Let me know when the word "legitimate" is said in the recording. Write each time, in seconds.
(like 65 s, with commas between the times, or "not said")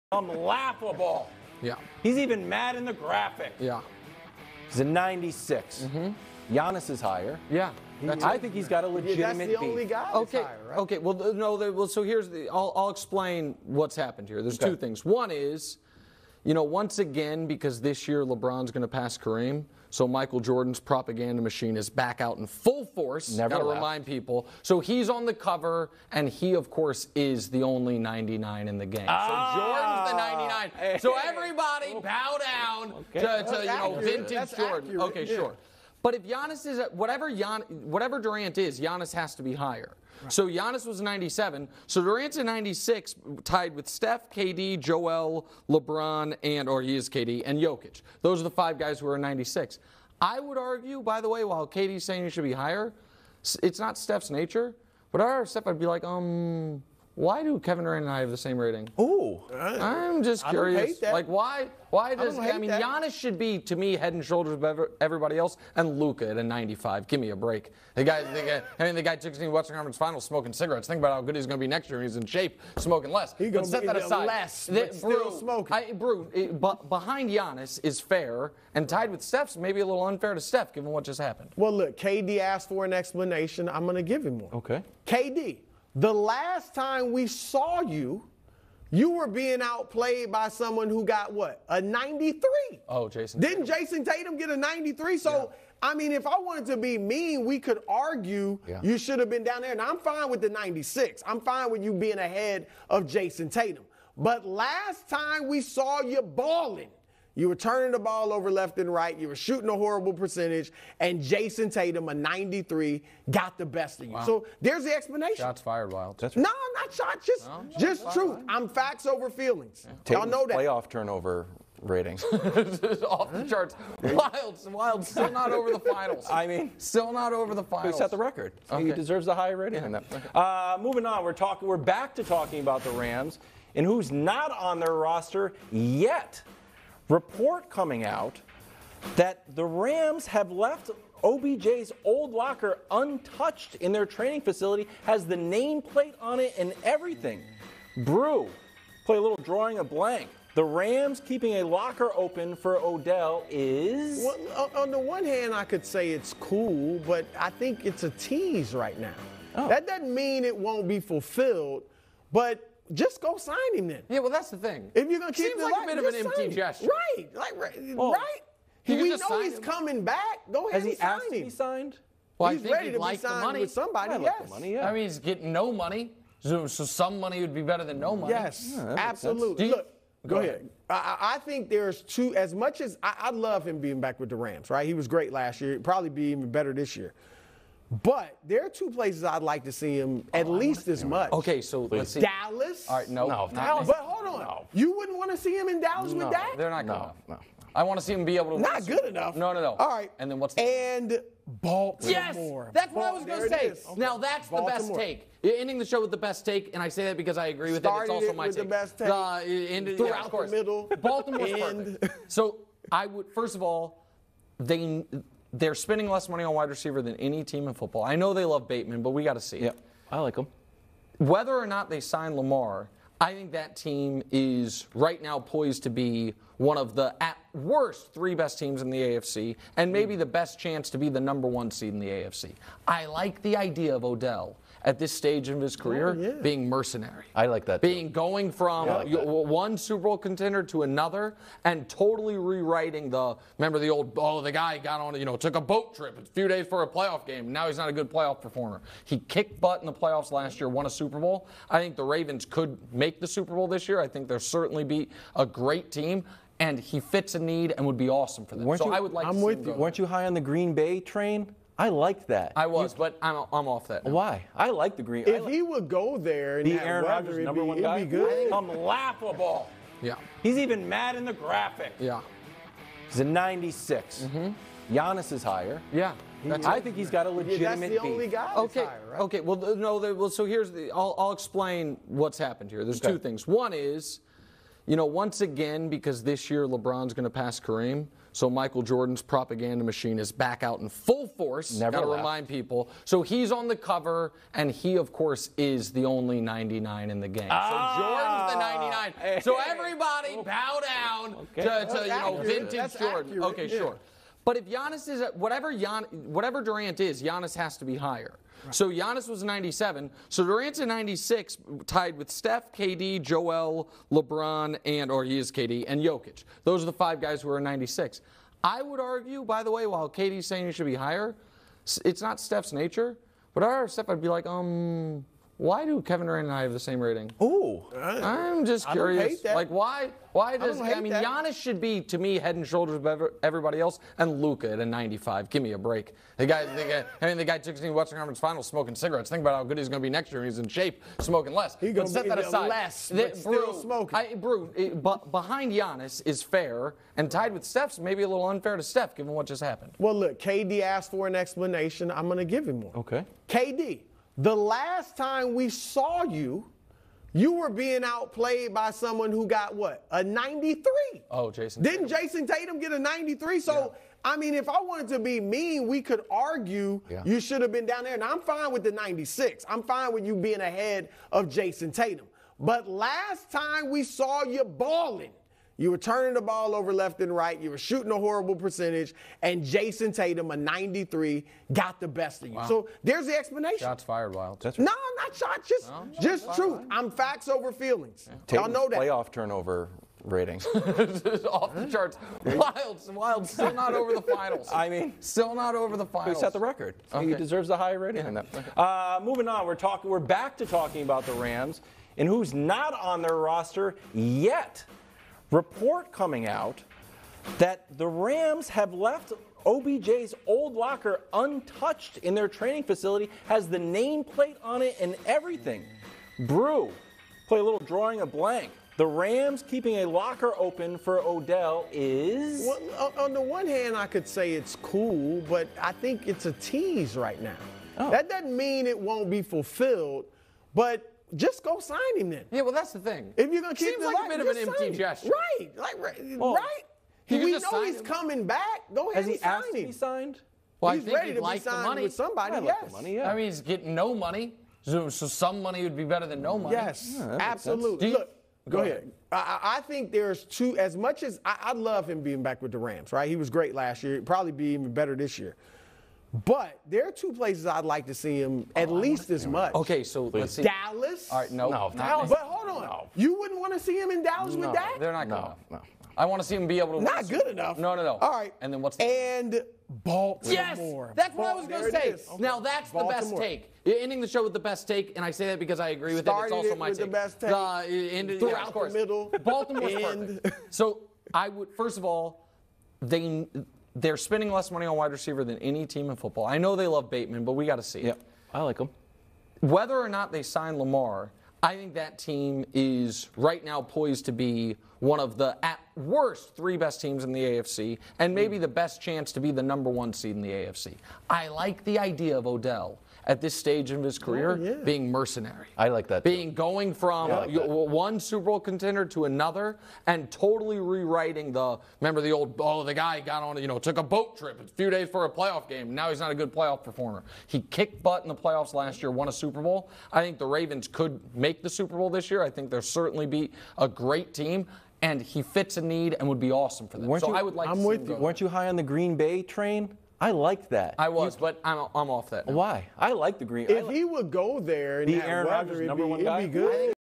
8 s, 277 s.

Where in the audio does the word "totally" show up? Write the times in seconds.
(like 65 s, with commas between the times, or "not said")
241 s, 510 s.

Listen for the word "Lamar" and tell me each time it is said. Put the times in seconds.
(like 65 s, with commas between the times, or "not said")
222 s, 490 s.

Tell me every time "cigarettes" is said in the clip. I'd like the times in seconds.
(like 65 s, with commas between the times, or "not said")
70 s, 338 s.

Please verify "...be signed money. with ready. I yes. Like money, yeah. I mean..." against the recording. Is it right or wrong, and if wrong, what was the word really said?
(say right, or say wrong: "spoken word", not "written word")
wrong: "somebody", not "ready".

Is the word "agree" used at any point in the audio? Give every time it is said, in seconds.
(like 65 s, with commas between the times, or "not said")
207 s, 475 s.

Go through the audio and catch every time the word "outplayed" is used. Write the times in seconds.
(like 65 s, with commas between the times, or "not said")
89 s, 358 s.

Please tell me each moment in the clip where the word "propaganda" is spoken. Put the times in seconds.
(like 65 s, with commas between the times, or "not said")
20 s, 289 s.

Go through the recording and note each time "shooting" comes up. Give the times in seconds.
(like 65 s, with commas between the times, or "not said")
109 s, 377 s.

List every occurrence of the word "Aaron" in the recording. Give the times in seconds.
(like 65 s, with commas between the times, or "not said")
266 s, 535 s.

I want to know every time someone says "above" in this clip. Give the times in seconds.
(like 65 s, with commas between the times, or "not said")
64 s, 332 s.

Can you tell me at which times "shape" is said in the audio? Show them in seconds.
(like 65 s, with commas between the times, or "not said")
72 s, 340 s.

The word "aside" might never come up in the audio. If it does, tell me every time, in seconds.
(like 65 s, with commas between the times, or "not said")
73 s, 342 s.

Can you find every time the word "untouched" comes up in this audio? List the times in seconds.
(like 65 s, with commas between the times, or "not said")
142 s, 411 s.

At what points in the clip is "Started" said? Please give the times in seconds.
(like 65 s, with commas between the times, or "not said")
207 s, 476 s.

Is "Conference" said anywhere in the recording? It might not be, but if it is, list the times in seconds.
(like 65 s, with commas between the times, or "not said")
69 s, 338 s.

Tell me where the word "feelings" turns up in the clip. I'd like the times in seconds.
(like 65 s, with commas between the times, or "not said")
119 s, 387 s.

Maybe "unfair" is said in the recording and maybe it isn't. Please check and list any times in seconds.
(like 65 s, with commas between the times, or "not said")
80 s, 348 s.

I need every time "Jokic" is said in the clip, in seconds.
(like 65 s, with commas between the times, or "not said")
47 s, 316 s.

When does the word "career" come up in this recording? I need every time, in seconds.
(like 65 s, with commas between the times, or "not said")
235 s, 504 s.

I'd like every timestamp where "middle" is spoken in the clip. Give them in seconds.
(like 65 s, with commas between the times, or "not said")
210 s, 478 s.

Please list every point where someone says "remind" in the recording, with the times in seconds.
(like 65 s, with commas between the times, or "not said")
23 s, 292 s.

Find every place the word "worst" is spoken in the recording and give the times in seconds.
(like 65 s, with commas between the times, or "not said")
227 s, 495 s.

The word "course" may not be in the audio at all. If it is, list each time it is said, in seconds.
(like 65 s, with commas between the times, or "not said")
26 s, 295 s, 478 s.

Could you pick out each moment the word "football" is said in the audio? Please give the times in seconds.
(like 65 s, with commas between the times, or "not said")
217 s, 486 s.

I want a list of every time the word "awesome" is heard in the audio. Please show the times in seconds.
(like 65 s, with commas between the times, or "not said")
258 s, 526 s.